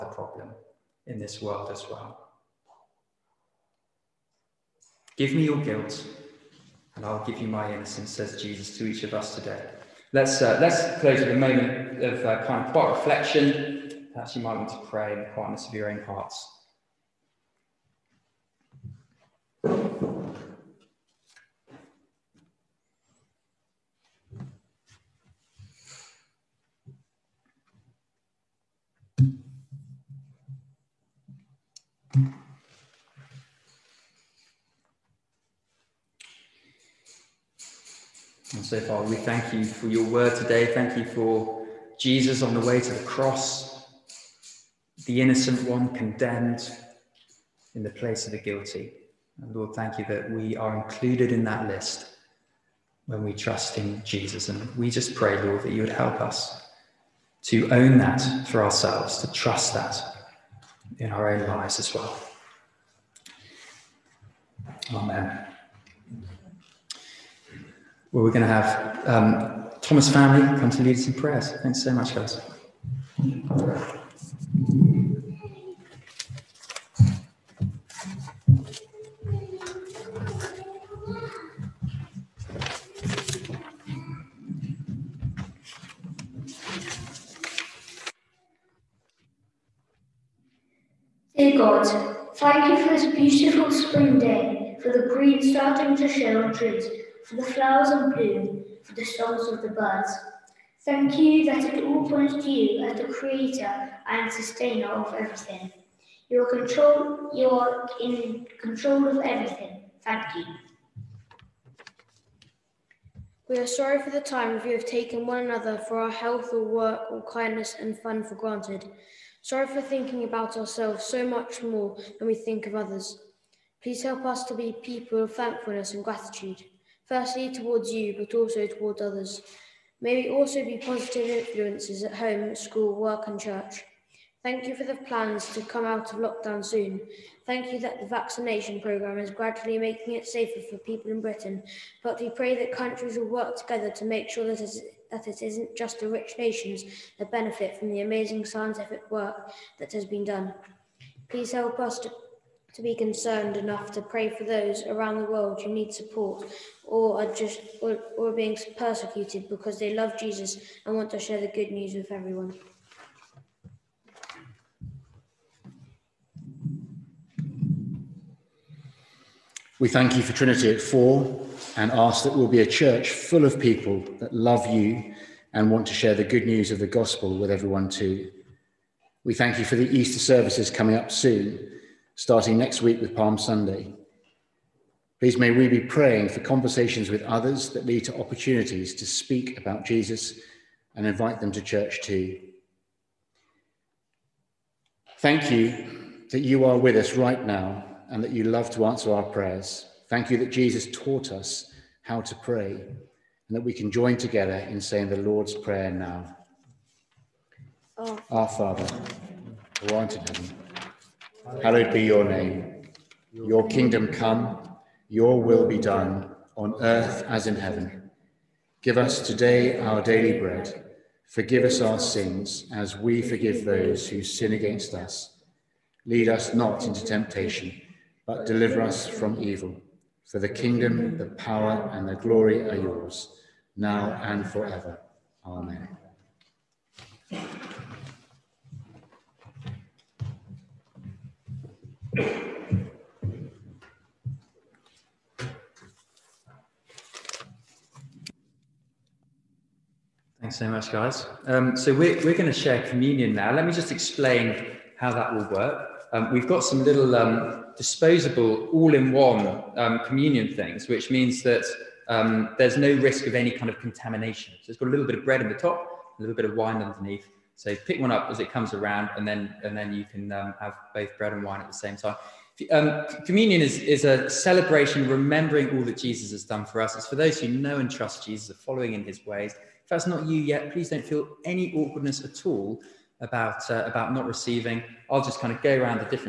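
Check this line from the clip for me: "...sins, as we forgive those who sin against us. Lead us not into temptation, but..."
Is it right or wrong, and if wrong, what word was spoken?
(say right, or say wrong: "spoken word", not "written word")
right.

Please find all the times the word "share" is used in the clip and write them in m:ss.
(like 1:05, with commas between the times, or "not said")
2:41, 2:55, 4:12.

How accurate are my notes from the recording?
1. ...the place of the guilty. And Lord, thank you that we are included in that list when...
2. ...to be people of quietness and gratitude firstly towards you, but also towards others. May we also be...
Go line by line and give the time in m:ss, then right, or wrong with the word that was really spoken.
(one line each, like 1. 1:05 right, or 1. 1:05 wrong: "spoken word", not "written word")
1. 0:47 right
2. 2:04 wrong: "thankfulness", not "quietness".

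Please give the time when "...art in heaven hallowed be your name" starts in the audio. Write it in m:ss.
3:29.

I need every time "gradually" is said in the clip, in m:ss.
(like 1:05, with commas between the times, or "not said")
2:19.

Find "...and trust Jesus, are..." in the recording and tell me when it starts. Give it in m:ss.
4:37.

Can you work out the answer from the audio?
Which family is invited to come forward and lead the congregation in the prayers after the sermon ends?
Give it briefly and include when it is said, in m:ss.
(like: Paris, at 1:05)
Thomas, at 1:09.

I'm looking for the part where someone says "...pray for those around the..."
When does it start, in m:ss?
2:34.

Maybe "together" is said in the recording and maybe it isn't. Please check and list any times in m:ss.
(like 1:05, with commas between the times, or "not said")
2:23, 3:24.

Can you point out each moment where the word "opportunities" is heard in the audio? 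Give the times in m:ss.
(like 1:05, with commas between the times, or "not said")
3:08.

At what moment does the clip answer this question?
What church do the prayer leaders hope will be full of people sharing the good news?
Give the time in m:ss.
2:50.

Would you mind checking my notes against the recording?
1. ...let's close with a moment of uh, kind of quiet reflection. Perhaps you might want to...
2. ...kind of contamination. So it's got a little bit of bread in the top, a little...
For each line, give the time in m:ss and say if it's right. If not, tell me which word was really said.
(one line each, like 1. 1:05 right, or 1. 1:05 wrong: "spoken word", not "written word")
1. 0:10 right
2. 4:23 right.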